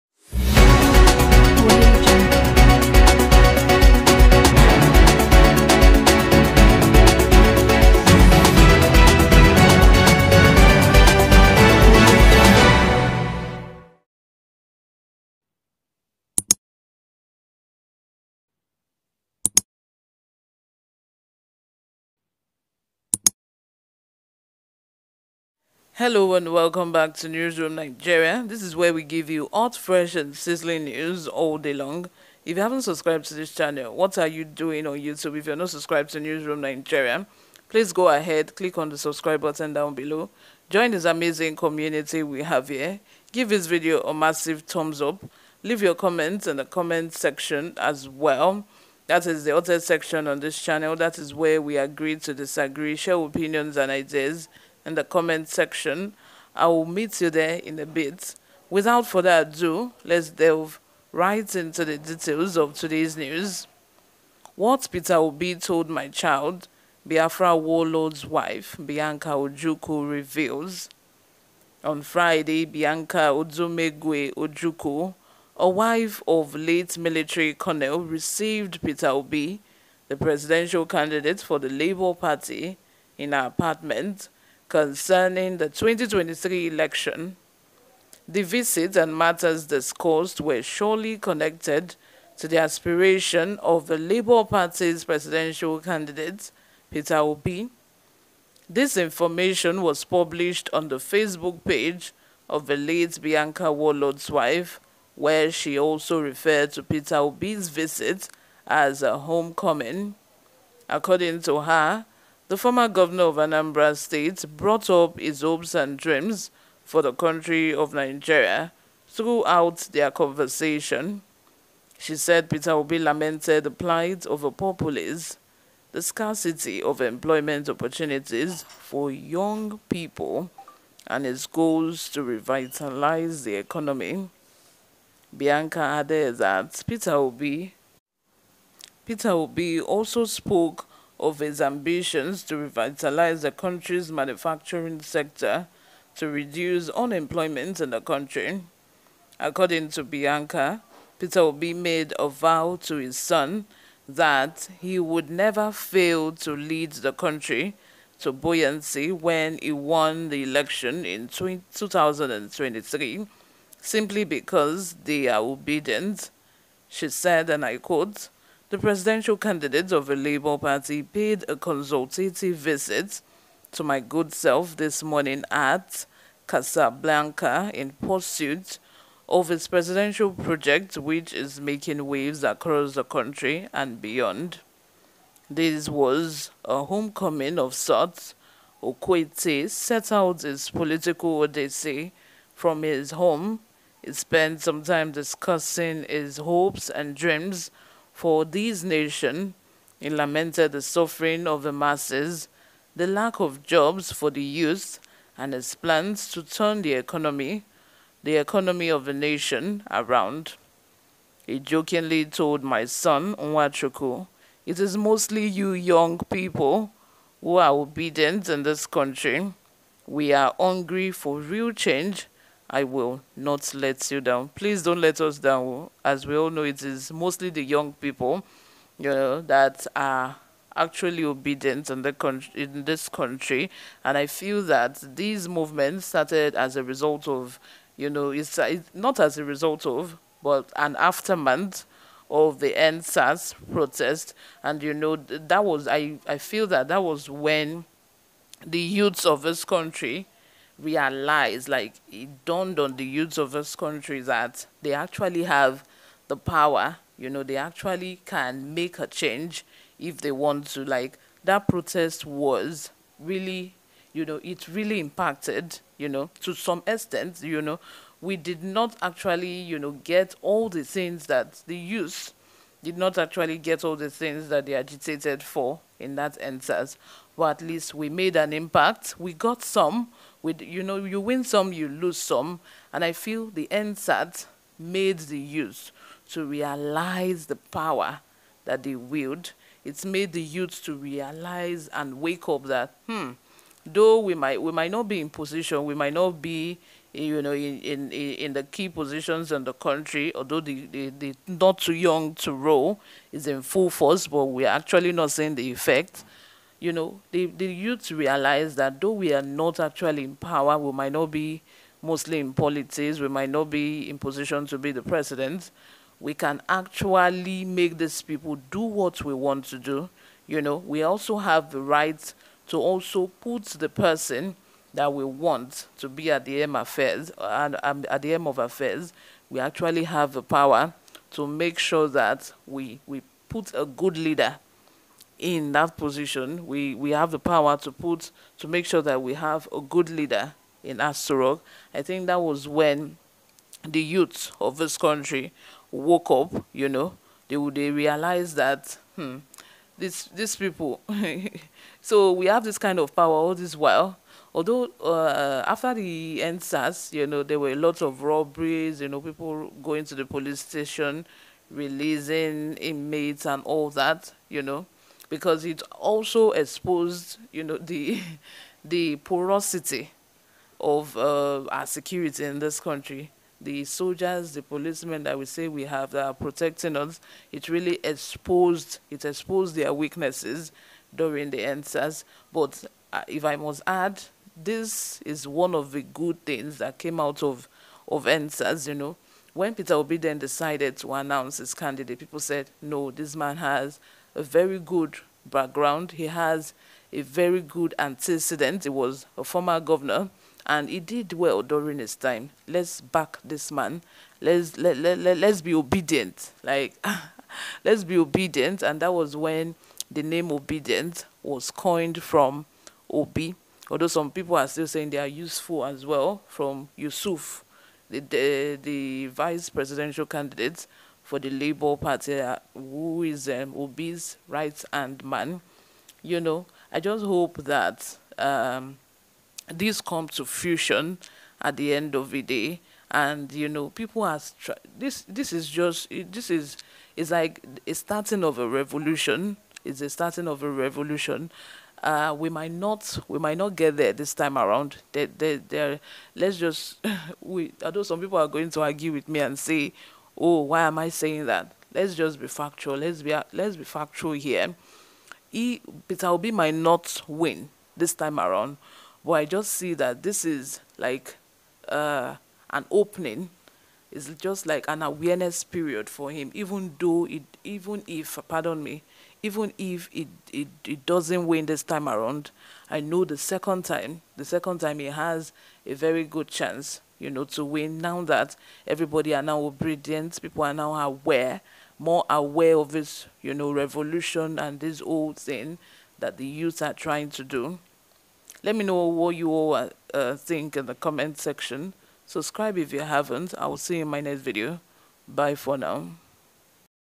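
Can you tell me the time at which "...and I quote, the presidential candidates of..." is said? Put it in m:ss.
2:47.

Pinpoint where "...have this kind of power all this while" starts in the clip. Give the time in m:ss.
5:52.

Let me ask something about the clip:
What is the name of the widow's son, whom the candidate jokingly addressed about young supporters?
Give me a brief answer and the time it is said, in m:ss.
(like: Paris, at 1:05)
Nwachuku, at 3:33.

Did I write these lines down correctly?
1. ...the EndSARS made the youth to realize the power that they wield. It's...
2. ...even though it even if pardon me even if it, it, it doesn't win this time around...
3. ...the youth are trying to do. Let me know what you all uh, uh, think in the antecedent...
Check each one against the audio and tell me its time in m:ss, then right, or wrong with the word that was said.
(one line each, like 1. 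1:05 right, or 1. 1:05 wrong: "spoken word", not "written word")
1. 4:43 right
2. 7:46 right
3. 8:06 wrong: "comment", not "antecedent".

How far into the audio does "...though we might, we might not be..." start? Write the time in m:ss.
4:53.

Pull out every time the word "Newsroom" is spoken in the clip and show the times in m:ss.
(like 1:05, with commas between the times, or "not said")
0:27, 0:36.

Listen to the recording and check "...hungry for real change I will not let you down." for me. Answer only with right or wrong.
right.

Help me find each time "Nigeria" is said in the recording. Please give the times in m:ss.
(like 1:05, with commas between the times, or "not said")
0:27, 0:36, 1:57.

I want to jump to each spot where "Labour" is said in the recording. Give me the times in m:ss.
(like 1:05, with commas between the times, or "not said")
1:21, 1:33, 2:50, 7:01.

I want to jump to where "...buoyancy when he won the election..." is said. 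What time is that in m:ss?
2:38.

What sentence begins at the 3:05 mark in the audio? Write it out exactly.
This was a homecoming of sorts.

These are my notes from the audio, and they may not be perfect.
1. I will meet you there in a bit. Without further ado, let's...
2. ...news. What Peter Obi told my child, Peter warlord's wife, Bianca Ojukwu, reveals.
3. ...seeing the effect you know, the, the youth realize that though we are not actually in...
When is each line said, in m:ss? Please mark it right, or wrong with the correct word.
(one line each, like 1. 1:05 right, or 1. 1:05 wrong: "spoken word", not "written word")
1. 0:56 right
2. 1:03 wrong: "Biafra", not "Peter"
3. 5:05 right.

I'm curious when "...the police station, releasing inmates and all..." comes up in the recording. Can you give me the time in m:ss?
6:00.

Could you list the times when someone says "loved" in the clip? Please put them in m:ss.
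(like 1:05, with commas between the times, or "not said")
not said.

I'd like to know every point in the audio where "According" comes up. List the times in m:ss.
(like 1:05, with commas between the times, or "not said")
1:50, 2:29.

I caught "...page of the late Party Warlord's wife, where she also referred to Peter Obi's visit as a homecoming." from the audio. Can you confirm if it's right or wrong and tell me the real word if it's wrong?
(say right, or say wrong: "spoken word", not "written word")
wrong: "Bianca", not "Party".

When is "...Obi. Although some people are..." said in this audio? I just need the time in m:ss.
6:53.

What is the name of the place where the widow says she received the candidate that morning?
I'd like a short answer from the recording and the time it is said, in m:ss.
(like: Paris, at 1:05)
Casablanca, at 2:56.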